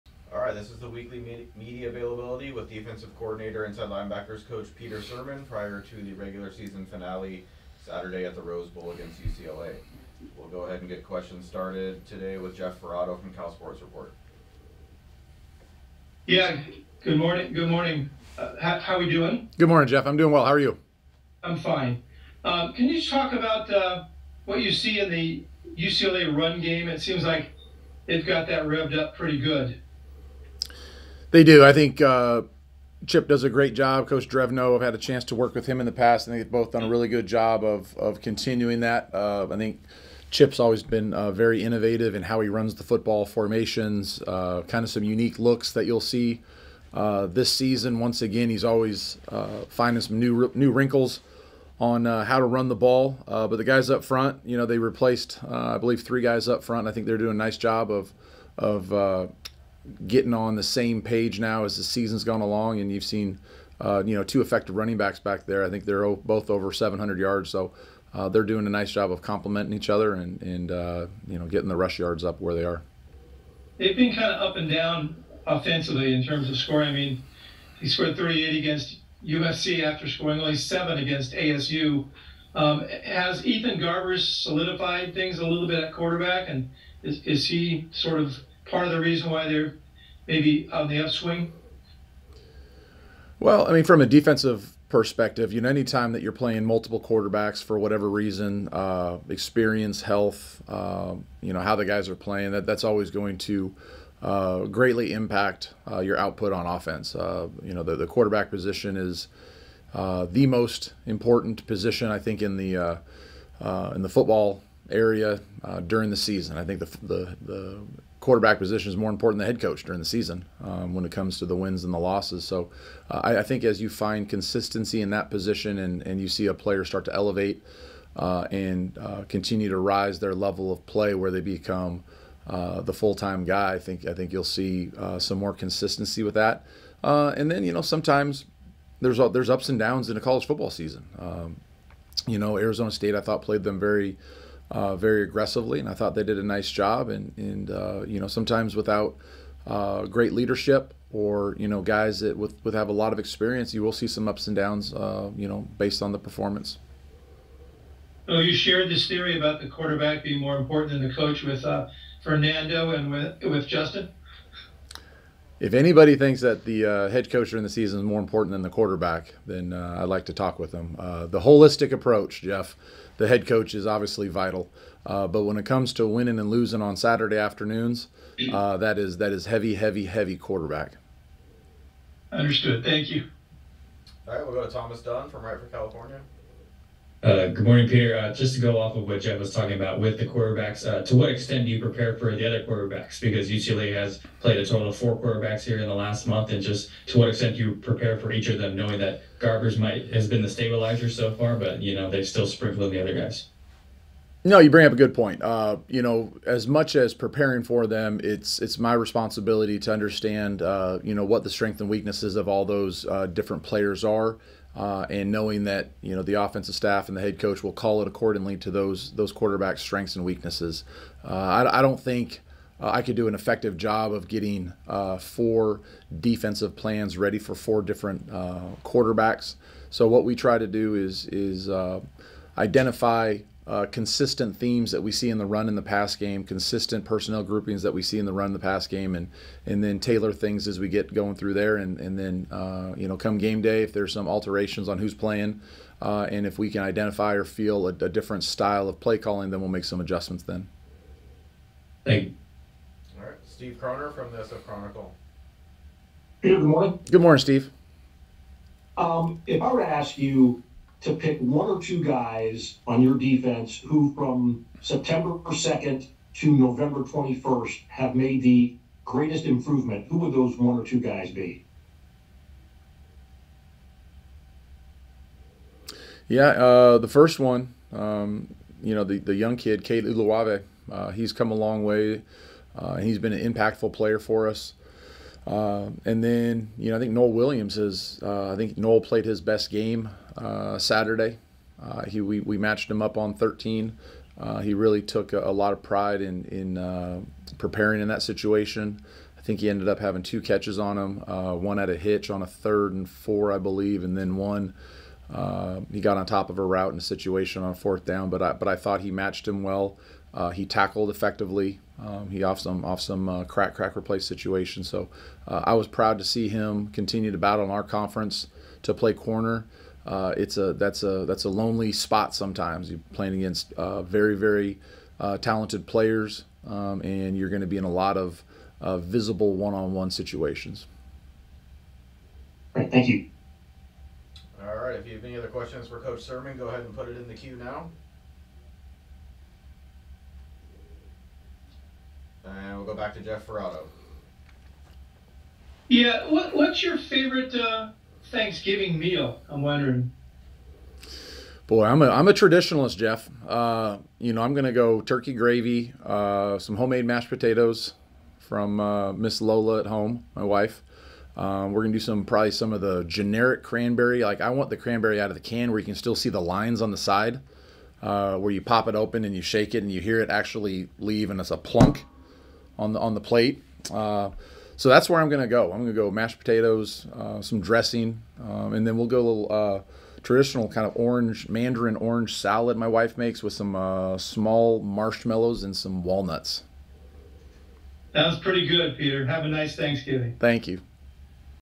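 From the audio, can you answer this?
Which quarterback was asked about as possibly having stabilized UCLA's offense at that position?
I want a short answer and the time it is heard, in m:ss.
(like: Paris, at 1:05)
Ethan Garbers, at 1:23.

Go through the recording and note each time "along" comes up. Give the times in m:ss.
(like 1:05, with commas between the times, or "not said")
1:02.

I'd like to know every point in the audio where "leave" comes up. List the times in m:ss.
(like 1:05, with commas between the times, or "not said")
6:10.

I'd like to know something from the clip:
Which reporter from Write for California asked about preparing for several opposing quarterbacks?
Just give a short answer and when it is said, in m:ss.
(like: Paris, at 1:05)
Thomas Dunn, at 3:04.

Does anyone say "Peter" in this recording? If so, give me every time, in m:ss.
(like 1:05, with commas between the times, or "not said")
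0:04, 3:07, 6:28.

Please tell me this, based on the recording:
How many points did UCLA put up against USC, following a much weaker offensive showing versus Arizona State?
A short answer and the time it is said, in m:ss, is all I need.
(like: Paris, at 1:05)
38, at 1:18.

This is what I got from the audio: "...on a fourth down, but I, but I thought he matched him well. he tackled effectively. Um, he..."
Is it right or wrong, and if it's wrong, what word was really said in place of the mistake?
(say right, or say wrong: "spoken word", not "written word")
right.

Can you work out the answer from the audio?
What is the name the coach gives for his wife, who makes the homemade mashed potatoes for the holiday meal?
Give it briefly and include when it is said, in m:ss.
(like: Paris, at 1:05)
Miss Lola, at 5:59.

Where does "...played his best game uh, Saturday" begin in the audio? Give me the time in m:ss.
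4:49.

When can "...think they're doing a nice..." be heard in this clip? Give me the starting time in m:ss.
0:56.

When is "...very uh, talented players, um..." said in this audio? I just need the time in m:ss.
5:24.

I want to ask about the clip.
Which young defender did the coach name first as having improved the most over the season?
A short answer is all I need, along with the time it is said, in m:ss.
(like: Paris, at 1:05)
Cade Uluave, at 4:39.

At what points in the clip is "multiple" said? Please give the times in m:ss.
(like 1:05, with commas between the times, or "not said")
1:36.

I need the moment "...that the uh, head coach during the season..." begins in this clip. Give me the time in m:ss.
2:46.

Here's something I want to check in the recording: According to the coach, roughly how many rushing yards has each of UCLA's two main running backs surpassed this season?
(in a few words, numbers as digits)
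700.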